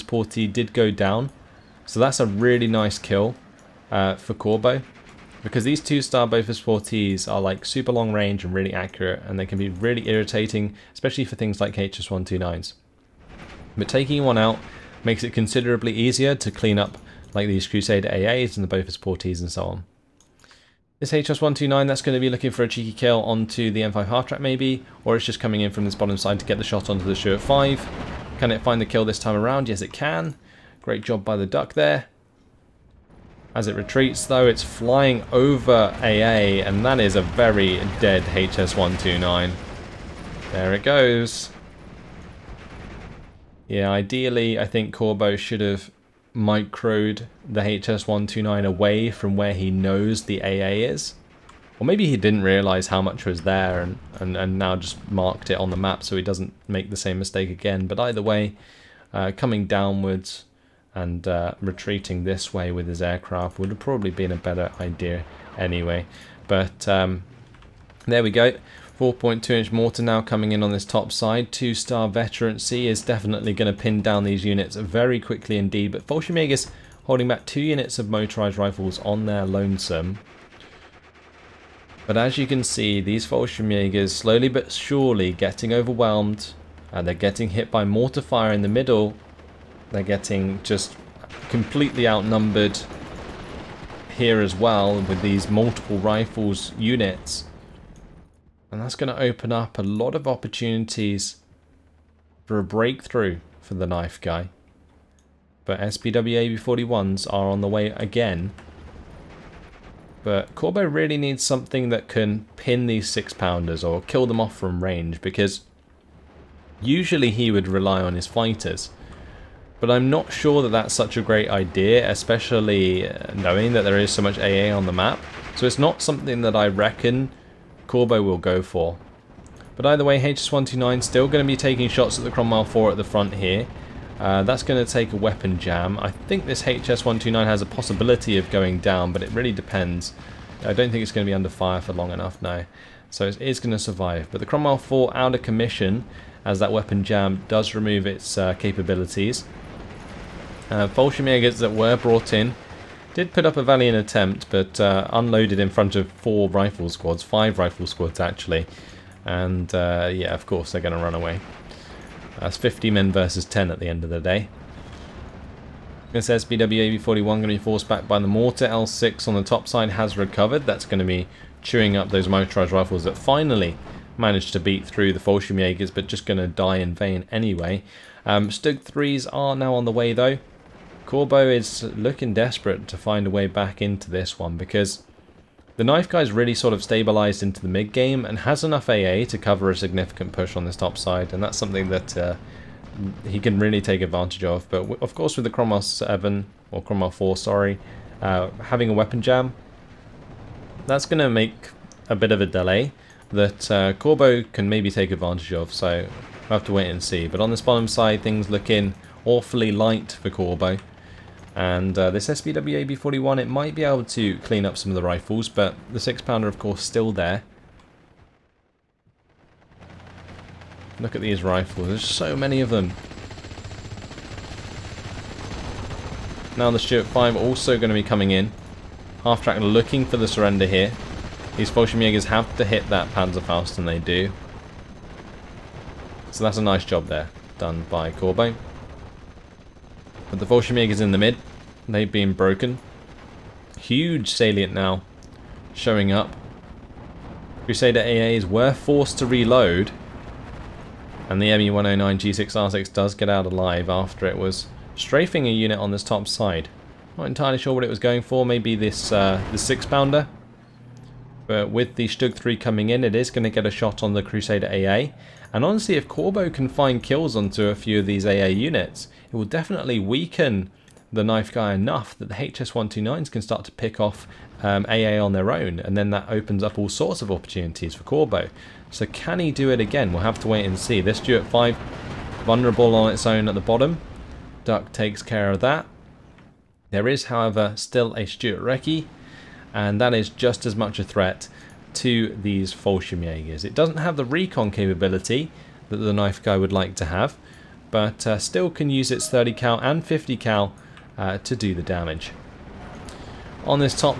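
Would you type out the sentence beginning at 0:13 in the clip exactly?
But taking one out makes it considerably easier to clean up like these Crusader AAs and the Bofors Portees and so on.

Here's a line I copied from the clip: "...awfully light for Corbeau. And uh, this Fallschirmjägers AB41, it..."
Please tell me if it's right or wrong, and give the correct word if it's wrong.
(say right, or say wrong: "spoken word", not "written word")
wrong: "SBW", not "Fallschirmjägers".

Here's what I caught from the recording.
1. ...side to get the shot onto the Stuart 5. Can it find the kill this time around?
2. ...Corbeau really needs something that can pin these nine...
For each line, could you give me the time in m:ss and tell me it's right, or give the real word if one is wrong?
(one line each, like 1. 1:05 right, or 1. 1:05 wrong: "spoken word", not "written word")
1. 0:26 right
2. 1:50 wrong: "six", not "nine".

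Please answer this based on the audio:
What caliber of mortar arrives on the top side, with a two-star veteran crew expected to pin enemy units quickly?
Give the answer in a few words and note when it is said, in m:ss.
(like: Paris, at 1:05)
4.2 inch, at 1:08.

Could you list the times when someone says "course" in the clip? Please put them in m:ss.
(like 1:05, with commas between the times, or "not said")
2:40, 3:15, 3:36.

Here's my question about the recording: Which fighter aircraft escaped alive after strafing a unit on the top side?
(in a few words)
ME-109 G6R6.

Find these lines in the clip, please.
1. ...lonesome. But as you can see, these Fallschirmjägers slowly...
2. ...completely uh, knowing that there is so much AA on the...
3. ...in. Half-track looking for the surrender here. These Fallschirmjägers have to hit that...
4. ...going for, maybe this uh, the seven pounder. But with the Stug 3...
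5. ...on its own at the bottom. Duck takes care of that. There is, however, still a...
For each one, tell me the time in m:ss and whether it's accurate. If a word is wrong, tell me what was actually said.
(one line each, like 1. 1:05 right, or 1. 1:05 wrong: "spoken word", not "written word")
1. 1:19 right
2. 2:02 wrong: "especially", not "completely"
3. 3:48 right
4. 4:17 wrong: "six", not "seven"
5. 4:42 right.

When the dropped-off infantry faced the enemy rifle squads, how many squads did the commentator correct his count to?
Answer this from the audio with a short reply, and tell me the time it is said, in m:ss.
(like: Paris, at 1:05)
5, at 2:37.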